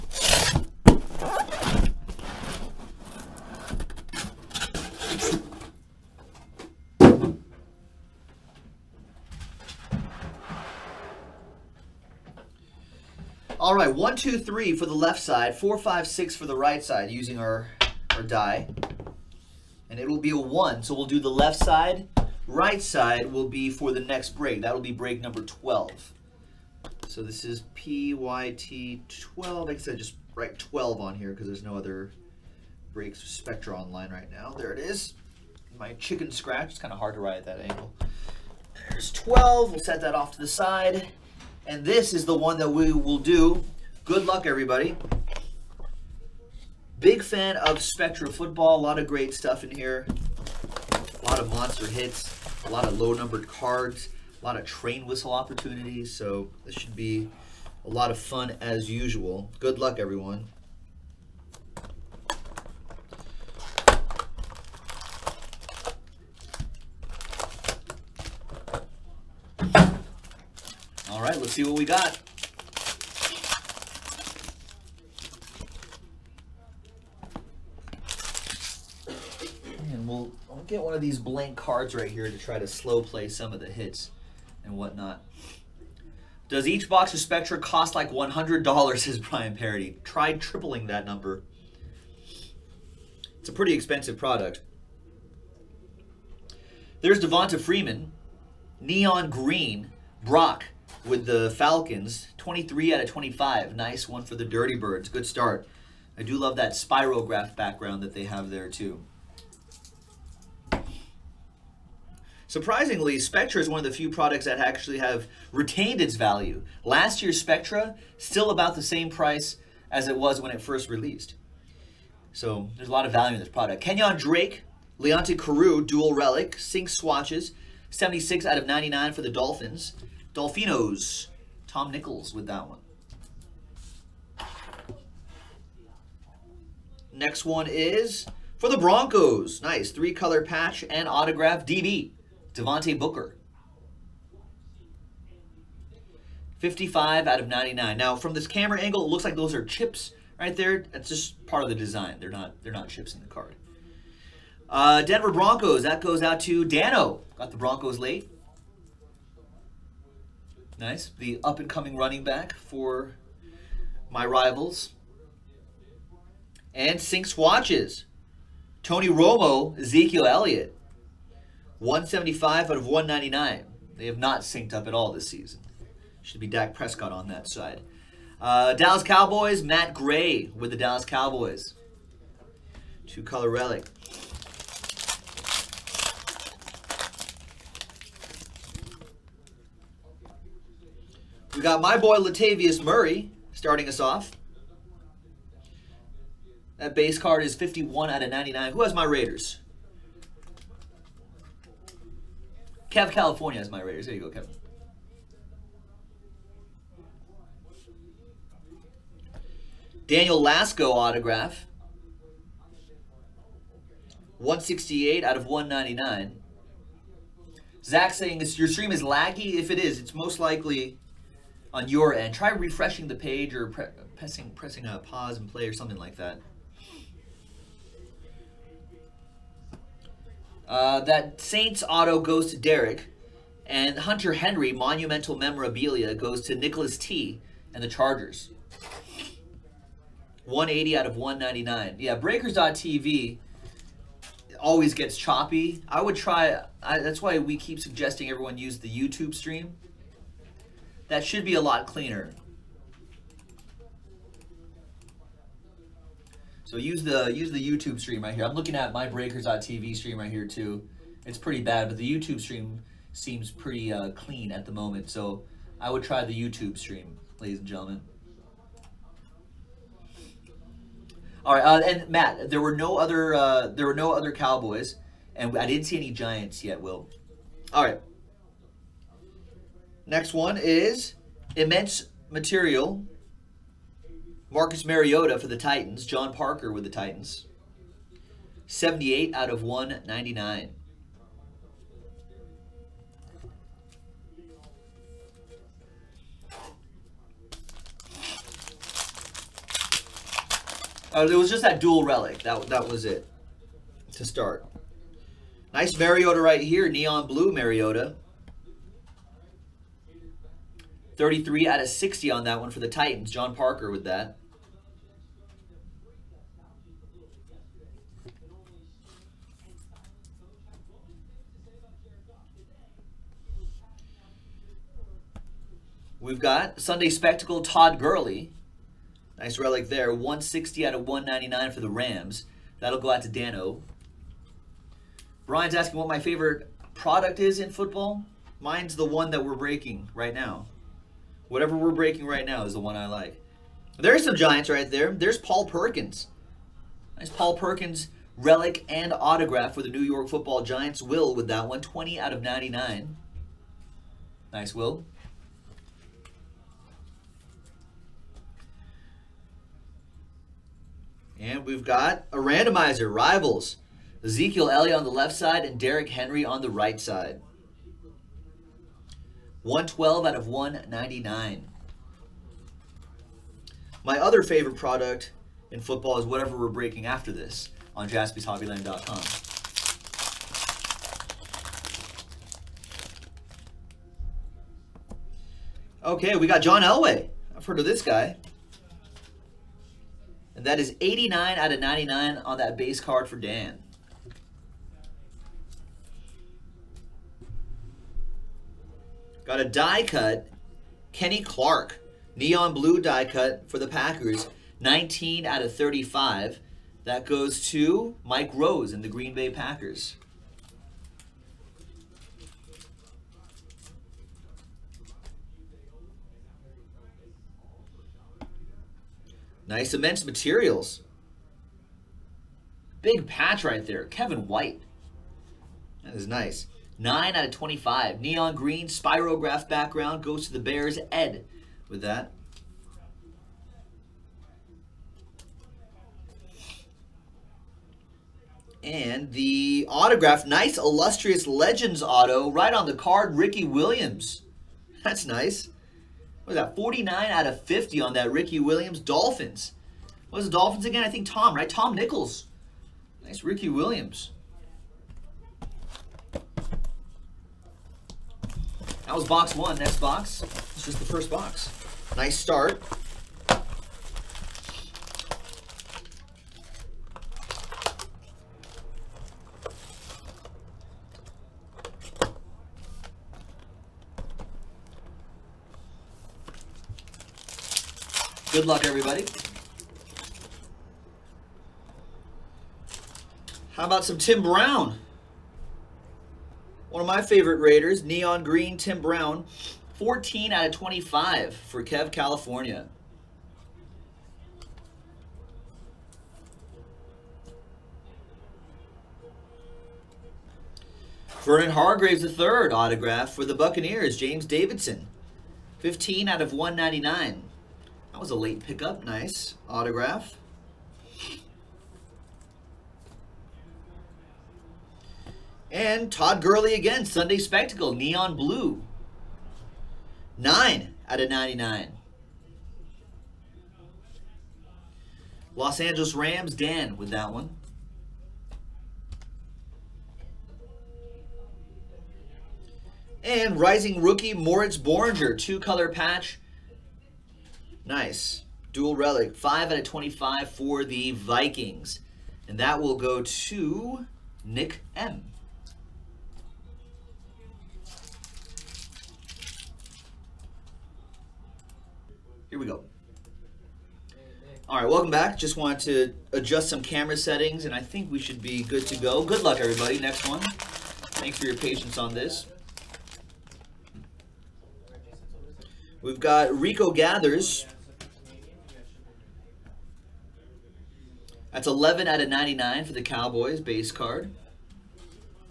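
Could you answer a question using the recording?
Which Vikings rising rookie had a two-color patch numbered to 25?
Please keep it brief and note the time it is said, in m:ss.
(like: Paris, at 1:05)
Moritz Boehringer, at 8:54.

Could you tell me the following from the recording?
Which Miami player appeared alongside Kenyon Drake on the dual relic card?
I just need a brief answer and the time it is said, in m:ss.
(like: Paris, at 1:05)
Leonte Carroo, at 2:04.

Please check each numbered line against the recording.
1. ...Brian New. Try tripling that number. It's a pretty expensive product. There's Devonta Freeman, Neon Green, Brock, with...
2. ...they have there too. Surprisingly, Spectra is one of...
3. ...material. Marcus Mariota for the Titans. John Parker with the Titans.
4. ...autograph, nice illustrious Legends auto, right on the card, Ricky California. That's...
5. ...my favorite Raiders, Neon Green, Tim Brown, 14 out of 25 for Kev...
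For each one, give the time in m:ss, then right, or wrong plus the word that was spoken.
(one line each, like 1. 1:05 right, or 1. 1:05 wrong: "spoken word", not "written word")
1. 1:29 wrong: "Parody", not "New"
2. 1:48 right
3. 4:42 right
4. 7:19 wrong: "Williams", not "California"
5. 8:07 right.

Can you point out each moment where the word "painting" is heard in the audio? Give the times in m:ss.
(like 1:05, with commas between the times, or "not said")
not said.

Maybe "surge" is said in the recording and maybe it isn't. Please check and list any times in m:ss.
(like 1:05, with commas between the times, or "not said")
not said.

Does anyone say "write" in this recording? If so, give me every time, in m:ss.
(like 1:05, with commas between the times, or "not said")
0:30, 0:37.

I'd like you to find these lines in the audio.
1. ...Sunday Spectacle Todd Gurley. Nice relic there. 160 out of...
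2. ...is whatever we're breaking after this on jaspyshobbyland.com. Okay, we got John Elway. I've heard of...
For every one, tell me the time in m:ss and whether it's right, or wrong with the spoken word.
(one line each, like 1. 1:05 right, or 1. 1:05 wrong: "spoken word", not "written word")
1. 5:26 right
2. 6:16 right.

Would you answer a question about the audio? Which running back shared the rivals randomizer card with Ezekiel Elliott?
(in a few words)
Derrick Henry.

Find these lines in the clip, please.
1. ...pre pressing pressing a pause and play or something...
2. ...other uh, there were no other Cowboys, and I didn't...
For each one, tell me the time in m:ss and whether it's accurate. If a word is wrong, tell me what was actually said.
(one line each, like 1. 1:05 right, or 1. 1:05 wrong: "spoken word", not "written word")
1. 3:43 right
2. 4:32 right.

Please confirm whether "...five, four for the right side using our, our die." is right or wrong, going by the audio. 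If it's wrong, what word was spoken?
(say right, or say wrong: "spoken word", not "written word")
wrong: "six", not "four".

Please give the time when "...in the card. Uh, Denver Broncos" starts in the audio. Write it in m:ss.
2:33.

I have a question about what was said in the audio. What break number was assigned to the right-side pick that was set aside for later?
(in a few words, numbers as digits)
12.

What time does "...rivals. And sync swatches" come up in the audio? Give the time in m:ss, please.
2:44.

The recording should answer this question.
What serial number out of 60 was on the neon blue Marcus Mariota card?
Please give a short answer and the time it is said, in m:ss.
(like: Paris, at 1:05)
33, at 5:11.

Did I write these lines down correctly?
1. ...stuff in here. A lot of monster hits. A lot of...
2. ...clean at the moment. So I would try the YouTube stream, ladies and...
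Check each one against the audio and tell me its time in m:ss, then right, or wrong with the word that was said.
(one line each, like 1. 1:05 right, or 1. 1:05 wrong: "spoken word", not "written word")
1. 0:49 right
2. 4:24 right.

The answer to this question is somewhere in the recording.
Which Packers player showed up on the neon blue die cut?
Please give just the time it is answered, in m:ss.
6:41.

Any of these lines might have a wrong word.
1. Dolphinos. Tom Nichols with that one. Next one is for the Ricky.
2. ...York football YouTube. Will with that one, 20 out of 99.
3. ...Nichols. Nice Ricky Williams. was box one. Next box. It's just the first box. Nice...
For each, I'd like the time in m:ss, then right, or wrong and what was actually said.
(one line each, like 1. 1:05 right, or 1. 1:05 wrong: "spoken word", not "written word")
1. 2:10 wrong: "Broncos", not "Ricky"
2. 5:50 wrong: "Giants", not "YouTube"
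3. 7:31 right.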